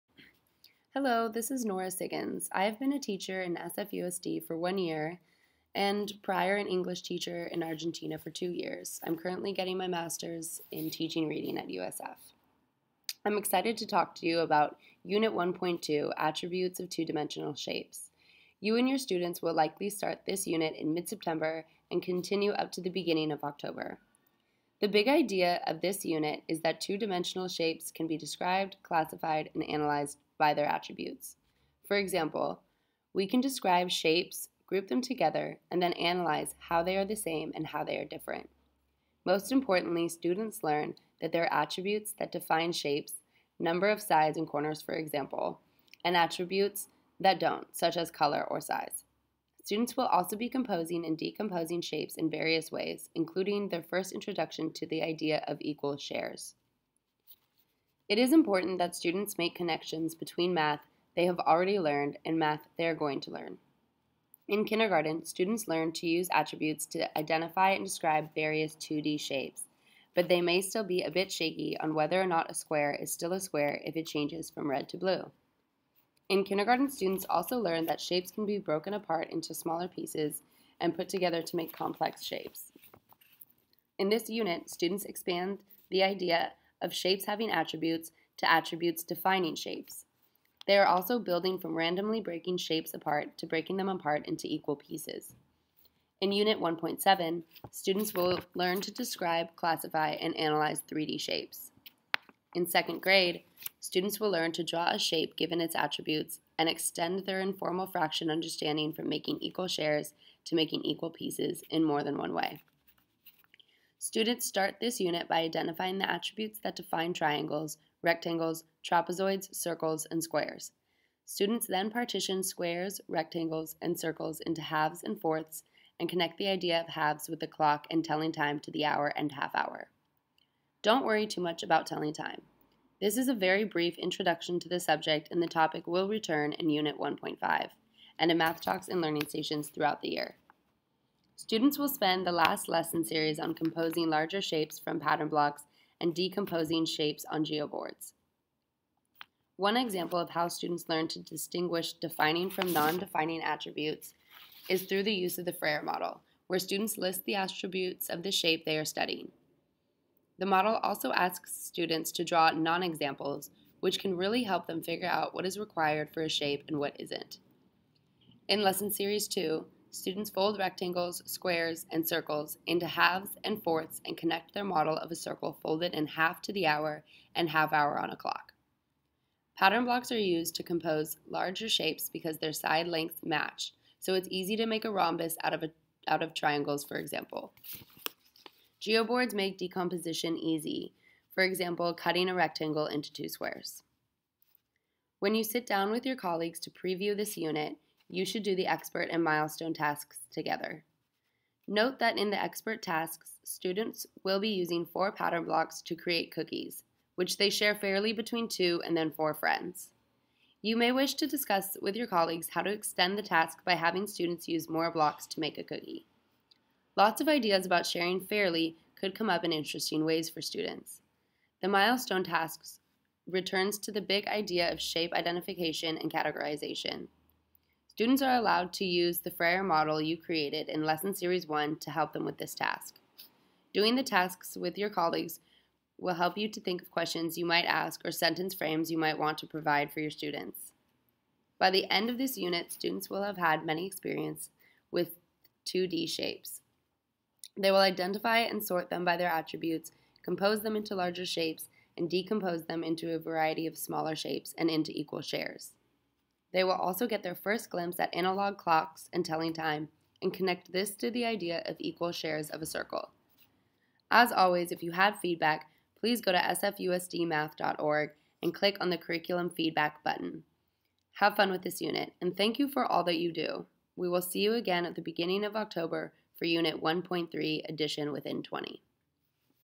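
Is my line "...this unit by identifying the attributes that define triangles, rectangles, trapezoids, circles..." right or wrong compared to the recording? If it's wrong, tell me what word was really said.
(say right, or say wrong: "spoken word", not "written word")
right.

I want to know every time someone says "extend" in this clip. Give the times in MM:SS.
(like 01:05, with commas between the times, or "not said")
01:46, 03:32.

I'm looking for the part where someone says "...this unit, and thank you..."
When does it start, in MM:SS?
04:31.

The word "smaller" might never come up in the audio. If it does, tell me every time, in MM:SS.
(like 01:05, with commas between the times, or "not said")
01:19, 04:13.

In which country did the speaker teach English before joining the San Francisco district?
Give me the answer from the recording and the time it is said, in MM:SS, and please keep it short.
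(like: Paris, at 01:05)
Argentina, at 00:07.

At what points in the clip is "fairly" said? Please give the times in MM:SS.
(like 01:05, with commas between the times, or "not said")
03:27, 03:38.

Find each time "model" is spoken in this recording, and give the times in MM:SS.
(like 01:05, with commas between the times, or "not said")
02:35, 02:40, 02:54, 03:49.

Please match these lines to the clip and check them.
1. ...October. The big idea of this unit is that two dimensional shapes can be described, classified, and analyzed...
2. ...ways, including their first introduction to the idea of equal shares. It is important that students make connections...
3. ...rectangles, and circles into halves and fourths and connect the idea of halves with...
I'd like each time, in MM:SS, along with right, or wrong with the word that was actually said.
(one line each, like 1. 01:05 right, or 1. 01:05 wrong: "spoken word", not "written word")
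1. 00:23 right
2. 00:52 right
3. 02:03 right.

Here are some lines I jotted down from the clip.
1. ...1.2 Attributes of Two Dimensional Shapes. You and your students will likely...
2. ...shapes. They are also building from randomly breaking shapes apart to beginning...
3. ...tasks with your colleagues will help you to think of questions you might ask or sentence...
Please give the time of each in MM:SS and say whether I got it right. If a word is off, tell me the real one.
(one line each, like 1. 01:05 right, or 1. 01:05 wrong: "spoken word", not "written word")
1. 00:15 right
2. 01:29 wrong: "breaking", not "beginning"
3. 03:54 right.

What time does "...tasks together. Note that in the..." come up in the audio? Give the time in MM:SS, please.
03:19.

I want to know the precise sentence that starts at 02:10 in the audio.
Don't worry too much about telling time.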